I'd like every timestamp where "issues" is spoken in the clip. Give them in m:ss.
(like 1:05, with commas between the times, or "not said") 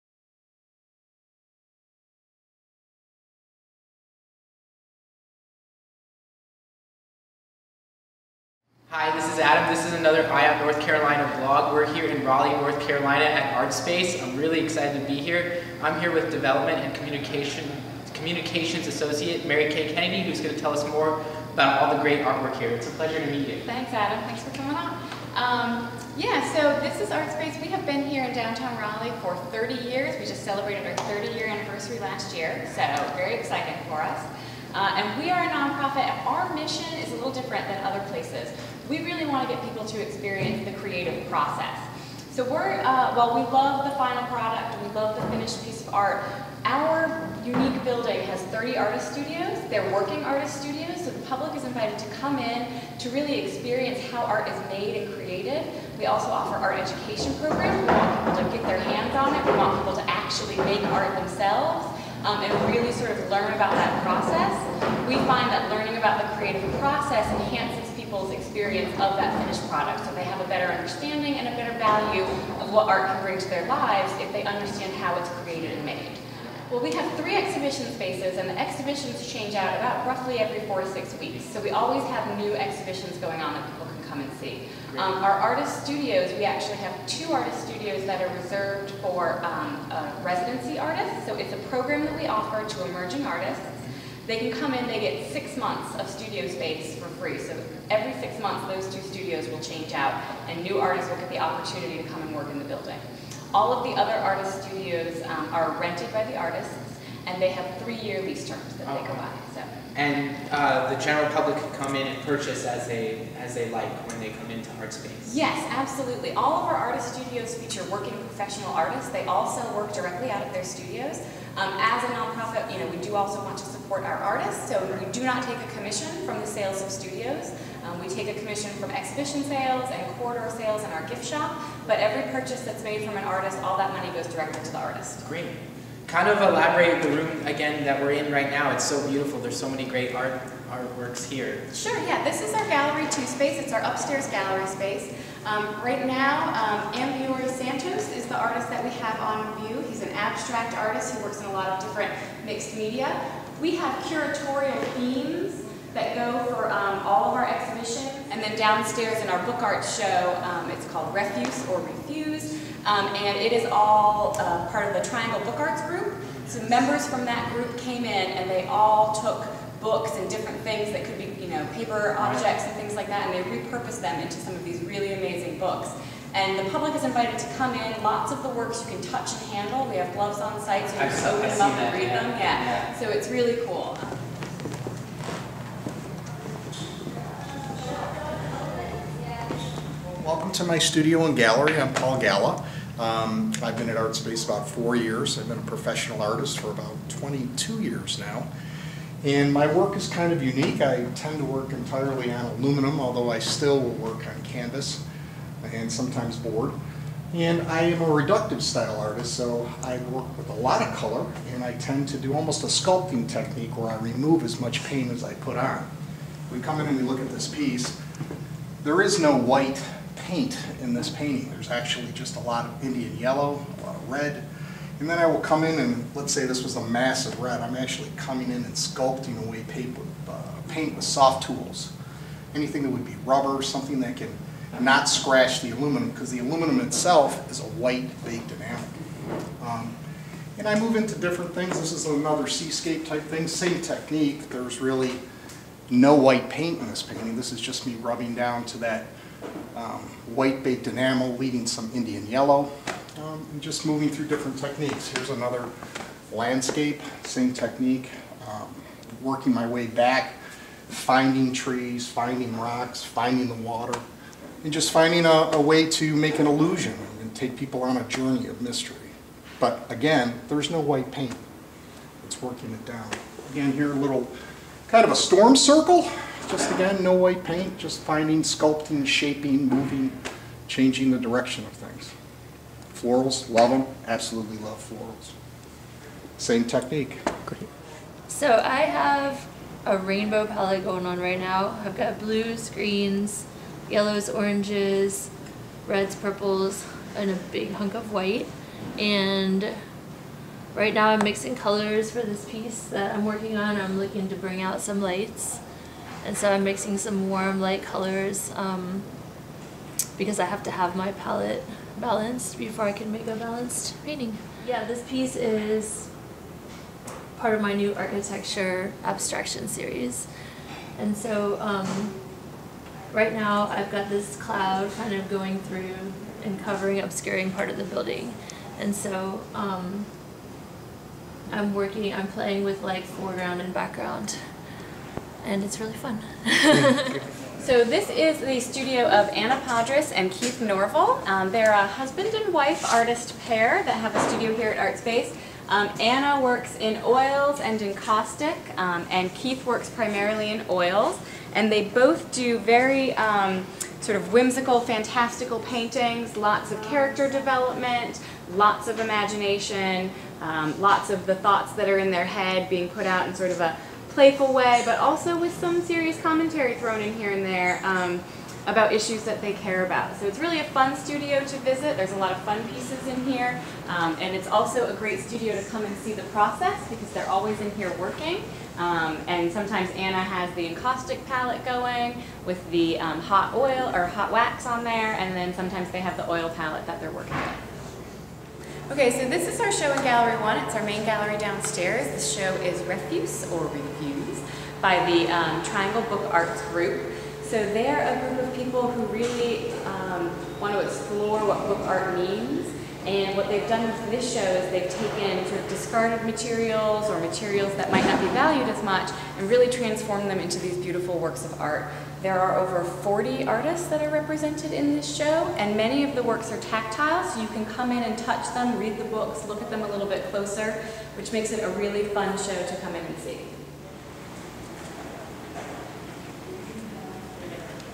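6:08.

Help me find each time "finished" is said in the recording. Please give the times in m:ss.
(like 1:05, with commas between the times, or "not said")
0:45, 1:09.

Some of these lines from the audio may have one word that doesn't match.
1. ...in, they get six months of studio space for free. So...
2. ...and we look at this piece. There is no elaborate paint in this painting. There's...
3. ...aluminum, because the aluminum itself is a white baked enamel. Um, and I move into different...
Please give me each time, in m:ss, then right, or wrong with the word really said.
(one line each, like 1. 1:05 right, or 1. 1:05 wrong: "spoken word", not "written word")
1. 1:34 right
2. 3:36 wrong: "white", not "elaborate"
3. 3:55 right.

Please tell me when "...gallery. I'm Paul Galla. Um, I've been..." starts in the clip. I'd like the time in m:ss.
3:11.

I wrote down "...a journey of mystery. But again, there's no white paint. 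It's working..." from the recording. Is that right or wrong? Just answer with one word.
right.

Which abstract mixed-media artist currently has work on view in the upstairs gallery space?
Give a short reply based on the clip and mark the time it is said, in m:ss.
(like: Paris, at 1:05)
Ambiori Santos, at 2:26.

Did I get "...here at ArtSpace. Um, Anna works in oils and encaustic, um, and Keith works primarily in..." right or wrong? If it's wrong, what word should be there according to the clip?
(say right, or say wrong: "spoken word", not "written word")
right.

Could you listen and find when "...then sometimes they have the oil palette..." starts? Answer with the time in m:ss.
6:25.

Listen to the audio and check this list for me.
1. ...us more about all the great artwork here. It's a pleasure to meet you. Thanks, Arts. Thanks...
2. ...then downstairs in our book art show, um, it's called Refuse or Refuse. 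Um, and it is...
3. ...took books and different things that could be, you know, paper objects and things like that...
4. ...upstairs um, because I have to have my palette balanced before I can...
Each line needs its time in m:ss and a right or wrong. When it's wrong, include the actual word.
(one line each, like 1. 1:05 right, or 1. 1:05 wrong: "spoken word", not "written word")
1. 0:20 wrong: "Adam", not "Arts"
2. 2:38 right
3. 2:49 right
4. 5:07 wrong: "colors", not "upstairs".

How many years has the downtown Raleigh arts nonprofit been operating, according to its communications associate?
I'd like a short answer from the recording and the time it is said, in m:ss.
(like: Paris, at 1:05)
30, at 0:29.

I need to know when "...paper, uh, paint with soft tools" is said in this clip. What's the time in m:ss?
3:49.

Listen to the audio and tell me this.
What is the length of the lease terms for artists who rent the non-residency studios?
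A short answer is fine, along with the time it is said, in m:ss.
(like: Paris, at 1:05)
3 years, at 1:47.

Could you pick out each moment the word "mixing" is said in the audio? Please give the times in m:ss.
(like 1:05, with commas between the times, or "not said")
5:01, 5:06.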